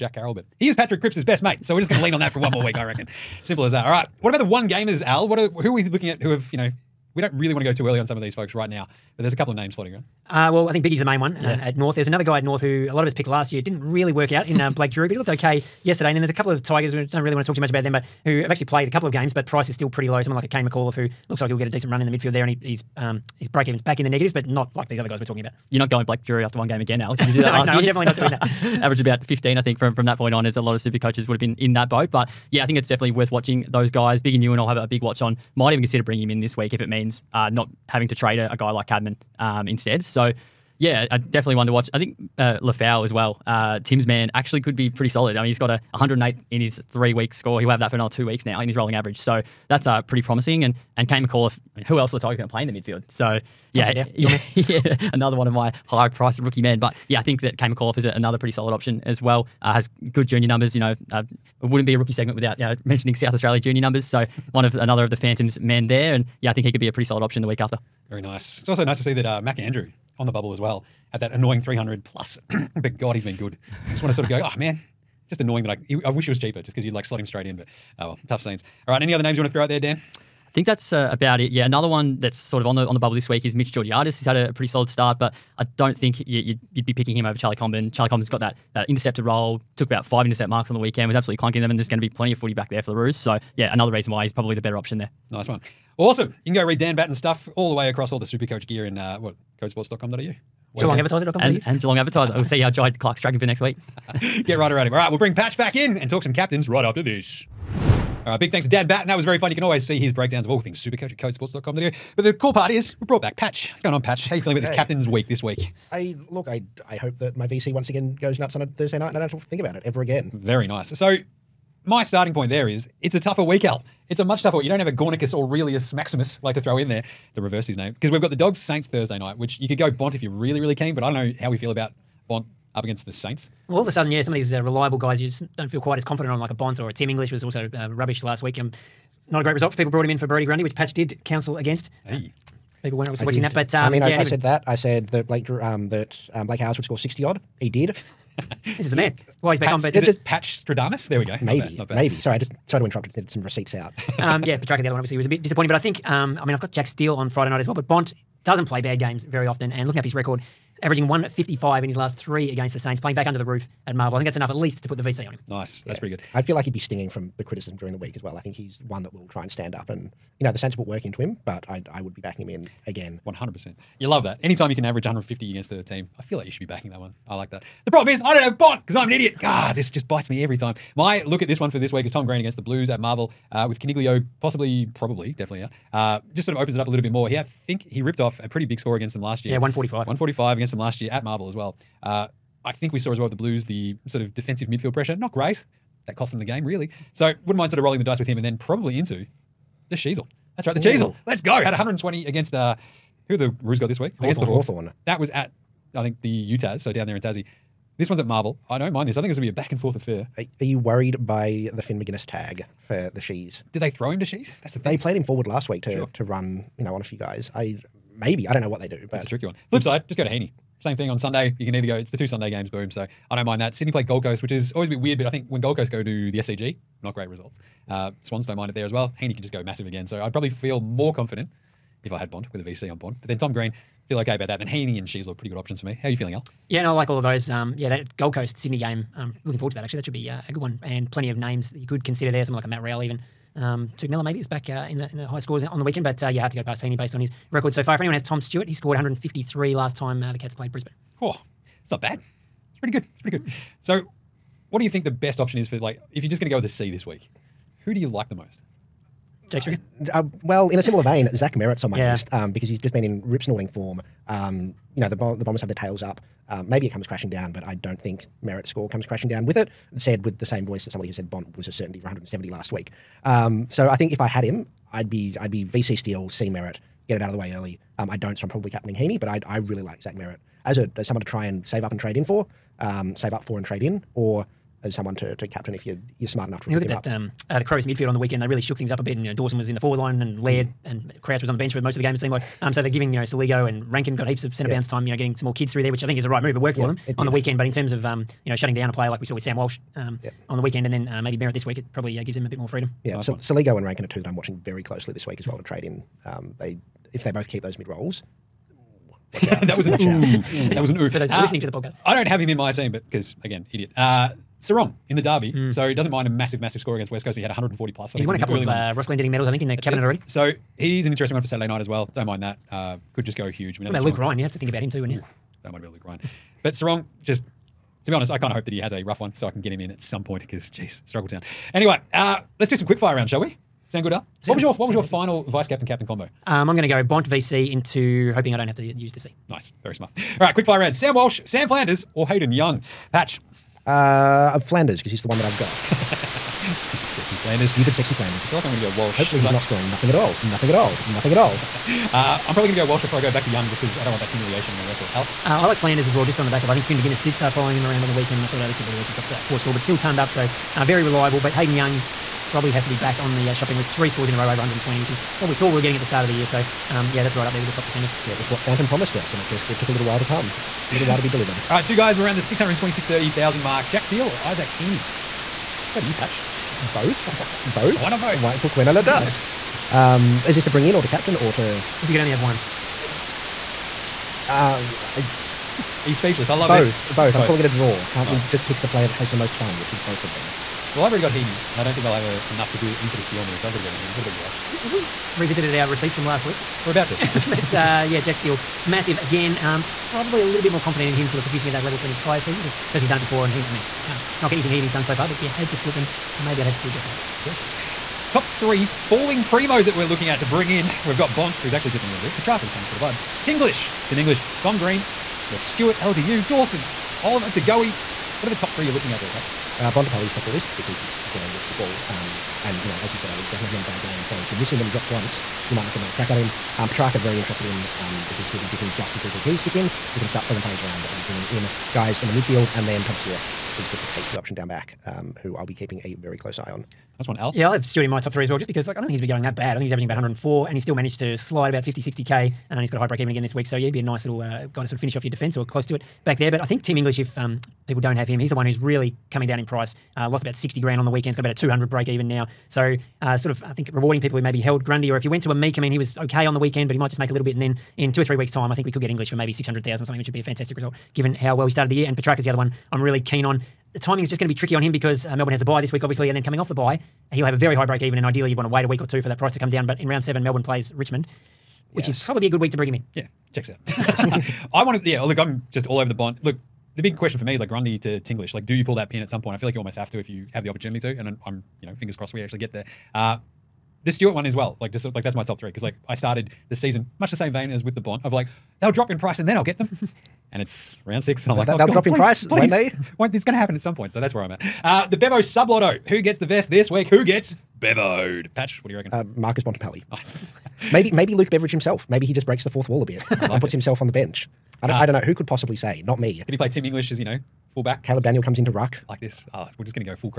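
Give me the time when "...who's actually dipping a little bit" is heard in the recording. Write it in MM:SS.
06:51.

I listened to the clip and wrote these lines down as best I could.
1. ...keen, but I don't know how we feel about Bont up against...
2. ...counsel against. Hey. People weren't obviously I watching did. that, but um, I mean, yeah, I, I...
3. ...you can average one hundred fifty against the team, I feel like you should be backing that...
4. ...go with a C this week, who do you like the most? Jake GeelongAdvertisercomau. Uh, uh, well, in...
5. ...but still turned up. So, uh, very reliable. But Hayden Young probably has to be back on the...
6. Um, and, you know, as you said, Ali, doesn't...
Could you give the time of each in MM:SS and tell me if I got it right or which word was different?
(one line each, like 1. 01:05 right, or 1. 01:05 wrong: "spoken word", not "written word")
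1. 02:10 right
2. 02:21 right
3. 02:54 right
4. 04:16 wrong: "Stricker", not "GeelongAdvertisercomau"
5. 05:59 right
6. 07:02 right.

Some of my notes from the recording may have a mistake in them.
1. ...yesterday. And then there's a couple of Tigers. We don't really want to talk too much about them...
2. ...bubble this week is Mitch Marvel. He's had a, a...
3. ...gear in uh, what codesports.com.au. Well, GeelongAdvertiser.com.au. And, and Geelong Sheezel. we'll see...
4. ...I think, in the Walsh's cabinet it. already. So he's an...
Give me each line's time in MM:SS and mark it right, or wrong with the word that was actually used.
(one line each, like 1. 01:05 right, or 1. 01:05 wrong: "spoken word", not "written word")
1. 00:15 right
2. 01:22 wrong: "Georgiadis", not "Marvel"
3. 01:38 wrong: "Advertiser", not "Sheezel"
4. 05:19 wrong: "That", not "Walsh".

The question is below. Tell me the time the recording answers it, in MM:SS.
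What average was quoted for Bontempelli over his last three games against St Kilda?
02:41.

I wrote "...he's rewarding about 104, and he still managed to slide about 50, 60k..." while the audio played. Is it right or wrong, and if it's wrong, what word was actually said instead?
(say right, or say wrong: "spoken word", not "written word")
wrong: "averaging", not "rewarding".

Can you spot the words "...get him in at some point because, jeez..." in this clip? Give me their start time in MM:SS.
05:29.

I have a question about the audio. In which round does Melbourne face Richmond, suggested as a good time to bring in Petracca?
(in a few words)
Round 7.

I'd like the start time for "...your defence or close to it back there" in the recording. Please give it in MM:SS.
07:25.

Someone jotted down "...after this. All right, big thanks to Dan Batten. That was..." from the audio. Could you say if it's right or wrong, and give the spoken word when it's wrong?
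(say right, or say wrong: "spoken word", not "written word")
right.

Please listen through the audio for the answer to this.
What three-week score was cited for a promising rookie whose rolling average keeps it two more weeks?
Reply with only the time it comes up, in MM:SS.
00:45.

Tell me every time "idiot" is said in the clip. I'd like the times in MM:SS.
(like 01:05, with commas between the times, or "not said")
02:59, 05:13.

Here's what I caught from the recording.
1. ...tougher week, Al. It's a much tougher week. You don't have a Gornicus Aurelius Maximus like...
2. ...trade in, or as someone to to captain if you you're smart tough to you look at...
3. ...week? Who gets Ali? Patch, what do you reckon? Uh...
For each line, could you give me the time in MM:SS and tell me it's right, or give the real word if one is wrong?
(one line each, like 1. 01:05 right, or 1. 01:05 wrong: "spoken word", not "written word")
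1. 02:03 right
2. 04:43 wrong: "enough", not "tough"
3. 08:16 wrong: "Bevoed", not "Ali".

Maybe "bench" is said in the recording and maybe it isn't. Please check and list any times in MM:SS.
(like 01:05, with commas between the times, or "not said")
04:51, 08:24.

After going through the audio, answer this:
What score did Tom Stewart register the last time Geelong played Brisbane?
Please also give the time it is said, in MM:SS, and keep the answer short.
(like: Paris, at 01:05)
153, at 04:08.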